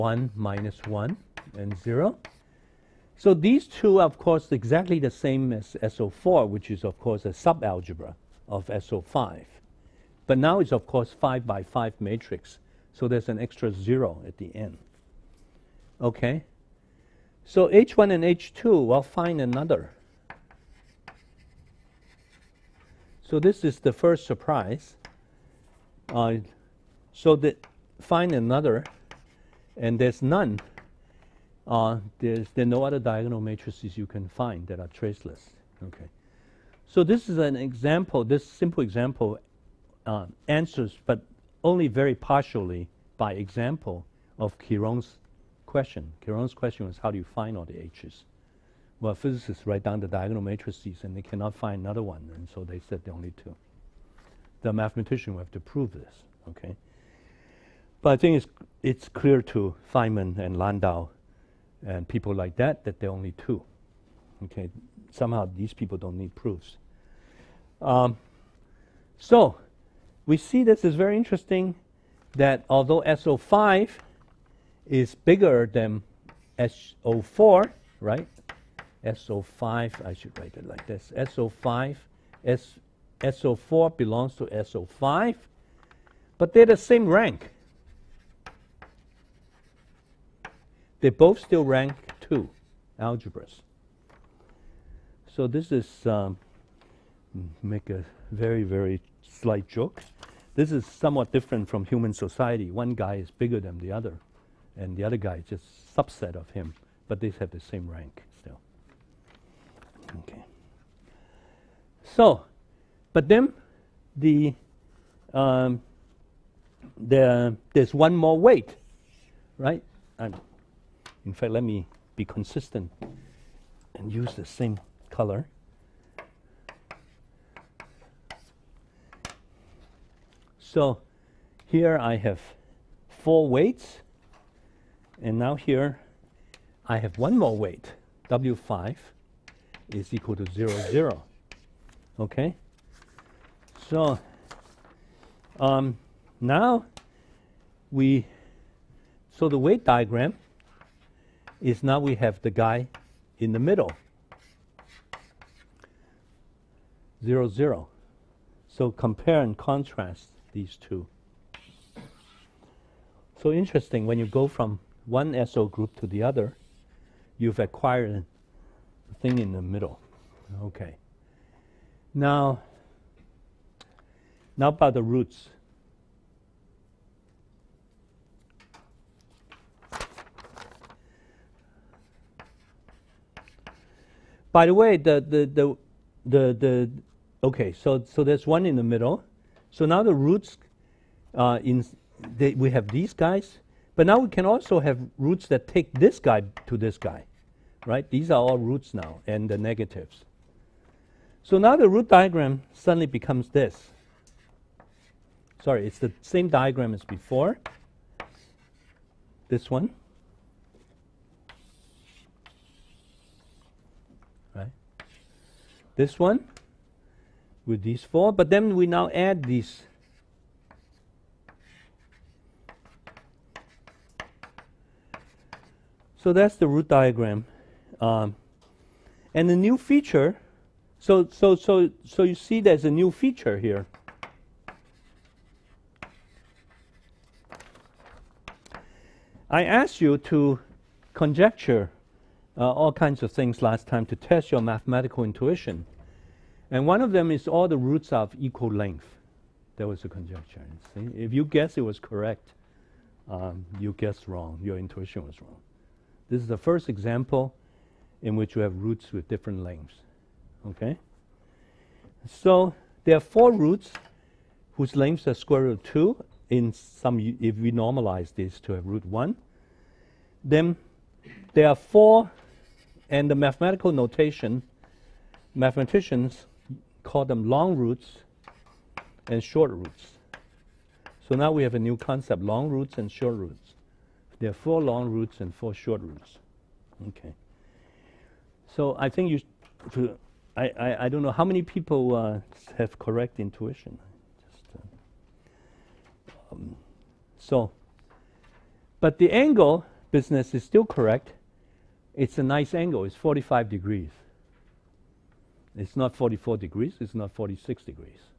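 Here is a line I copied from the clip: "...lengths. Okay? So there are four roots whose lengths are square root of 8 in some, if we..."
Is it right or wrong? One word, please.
wrong.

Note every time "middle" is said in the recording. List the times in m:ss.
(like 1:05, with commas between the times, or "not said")
2:33, 2:49, 3:08.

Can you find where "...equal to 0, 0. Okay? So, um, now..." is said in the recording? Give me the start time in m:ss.
2:20.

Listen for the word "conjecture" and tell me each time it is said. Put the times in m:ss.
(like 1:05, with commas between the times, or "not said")
4:01, 4:10.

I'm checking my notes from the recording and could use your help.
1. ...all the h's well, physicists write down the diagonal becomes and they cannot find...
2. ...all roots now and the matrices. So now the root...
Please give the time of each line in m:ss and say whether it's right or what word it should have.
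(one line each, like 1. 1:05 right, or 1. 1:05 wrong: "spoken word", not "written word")
1. 0:47 wrong: "matrices", not "becomes"
2. 3:18 wrong: "negatives", not "matrices".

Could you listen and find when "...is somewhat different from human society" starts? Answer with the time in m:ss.
1:40.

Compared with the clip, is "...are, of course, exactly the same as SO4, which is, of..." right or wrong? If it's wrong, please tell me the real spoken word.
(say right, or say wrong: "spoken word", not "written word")
right.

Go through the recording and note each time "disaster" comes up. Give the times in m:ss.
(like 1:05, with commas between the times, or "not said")
not said.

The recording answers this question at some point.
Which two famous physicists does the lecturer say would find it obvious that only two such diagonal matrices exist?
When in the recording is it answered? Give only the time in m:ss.
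0:59.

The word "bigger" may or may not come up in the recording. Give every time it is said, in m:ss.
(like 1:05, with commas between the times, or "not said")
1:15, 1:43.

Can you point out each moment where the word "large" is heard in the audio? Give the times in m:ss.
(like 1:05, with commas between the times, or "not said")
not said.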